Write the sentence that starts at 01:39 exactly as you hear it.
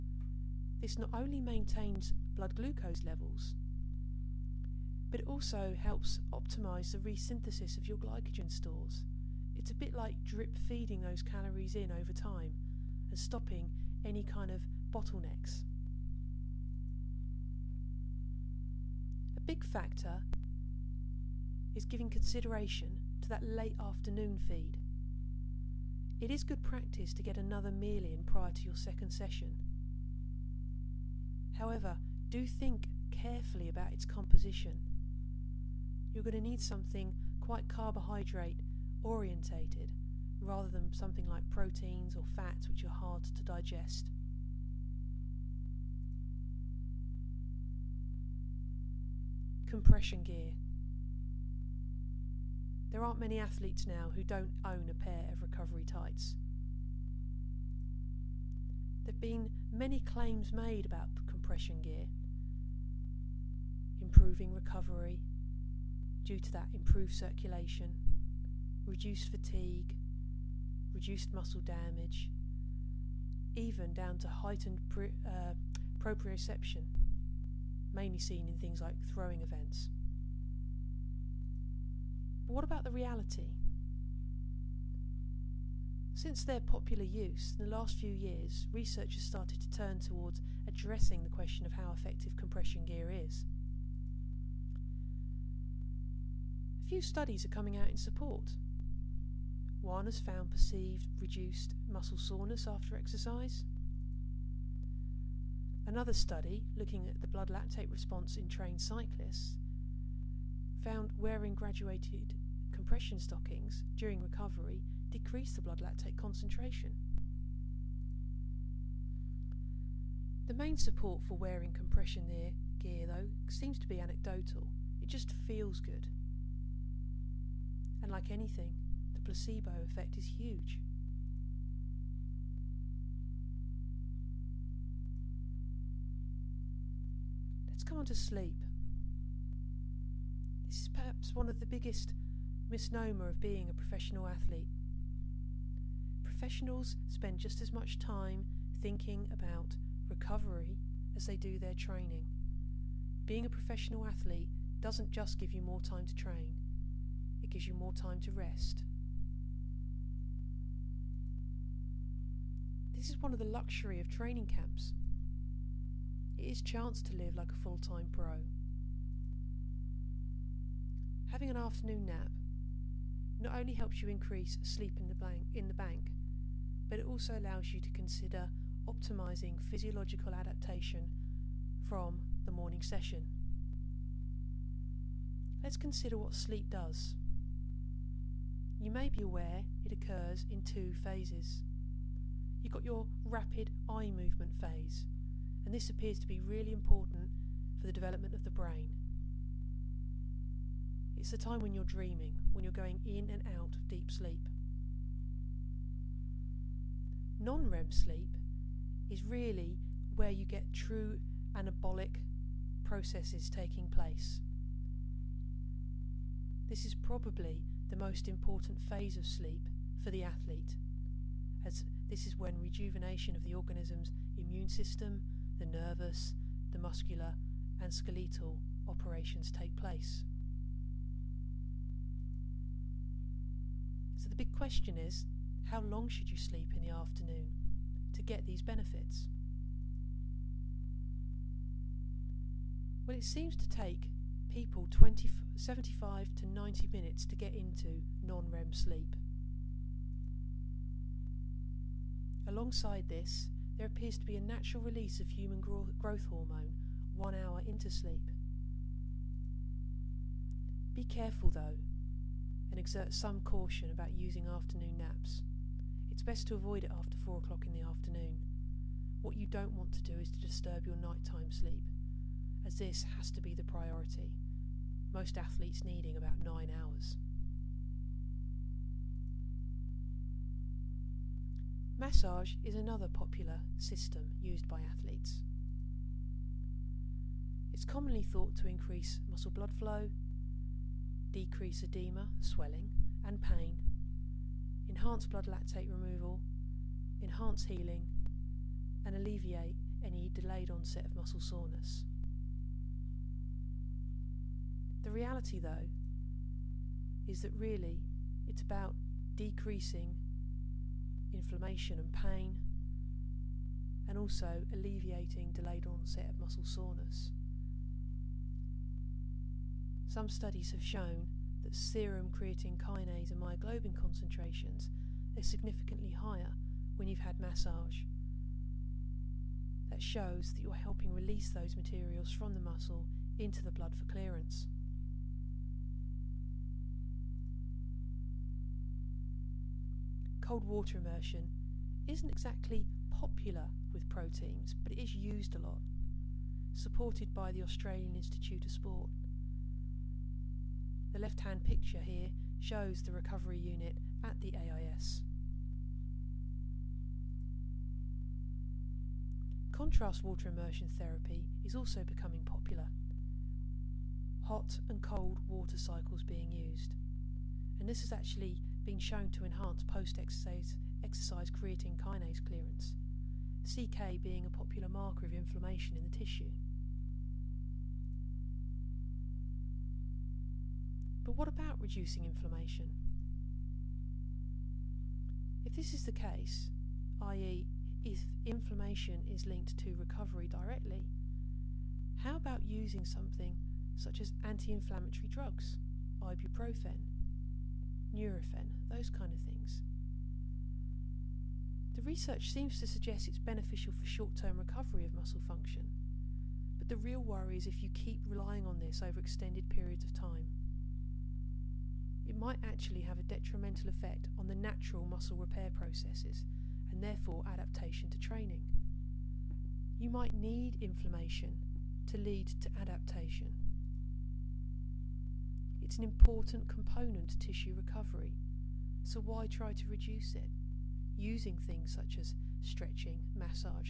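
One has found perceived reduced muscle soreness after exercise.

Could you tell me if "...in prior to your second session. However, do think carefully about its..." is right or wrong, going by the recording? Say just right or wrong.
right.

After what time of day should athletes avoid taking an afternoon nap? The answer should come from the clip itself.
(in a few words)
4 o'clock.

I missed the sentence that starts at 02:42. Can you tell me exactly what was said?
This is one of the luxury of training camps.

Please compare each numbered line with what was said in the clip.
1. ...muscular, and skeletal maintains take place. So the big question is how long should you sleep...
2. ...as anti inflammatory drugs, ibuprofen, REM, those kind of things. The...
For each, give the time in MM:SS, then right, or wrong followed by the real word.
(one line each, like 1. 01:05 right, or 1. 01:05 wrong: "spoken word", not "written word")
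1. 03:46 wrong: "operations", not "maintains"
2. 06:34 wrong: "Nurofen", not "REM".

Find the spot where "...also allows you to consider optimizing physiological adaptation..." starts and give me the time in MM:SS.
02:57.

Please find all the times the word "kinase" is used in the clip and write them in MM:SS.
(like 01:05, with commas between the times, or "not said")
05:22, 06:11.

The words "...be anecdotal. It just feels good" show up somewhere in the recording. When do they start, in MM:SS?
02:03.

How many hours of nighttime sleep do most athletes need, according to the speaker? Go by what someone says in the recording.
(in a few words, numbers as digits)
9 hours.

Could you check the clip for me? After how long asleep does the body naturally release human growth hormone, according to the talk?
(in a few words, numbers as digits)
1 hour.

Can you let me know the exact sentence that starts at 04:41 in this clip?
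Massage is another popular system used by athletes.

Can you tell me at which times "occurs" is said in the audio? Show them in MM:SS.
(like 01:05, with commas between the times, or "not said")
03:09.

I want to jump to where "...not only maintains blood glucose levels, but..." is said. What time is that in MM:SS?
00:00.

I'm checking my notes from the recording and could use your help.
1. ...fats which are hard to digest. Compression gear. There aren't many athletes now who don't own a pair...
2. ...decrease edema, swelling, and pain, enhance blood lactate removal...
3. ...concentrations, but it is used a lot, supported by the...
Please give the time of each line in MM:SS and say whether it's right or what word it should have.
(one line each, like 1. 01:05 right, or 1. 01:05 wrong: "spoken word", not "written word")
1. 00:42 right
2. 04:51 right
3. 05:44 wrong: "proteins", not "concentrations".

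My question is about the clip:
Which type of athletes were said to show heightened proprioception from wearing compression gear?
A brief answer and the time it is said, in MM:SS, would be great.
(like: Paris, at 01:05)
Throwing events, at 01:19.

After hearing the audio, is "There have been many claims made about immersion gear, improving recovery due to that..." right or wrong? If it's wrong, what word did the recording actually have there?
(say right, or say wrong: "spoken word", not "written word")
wrong: "compression", not "immersion".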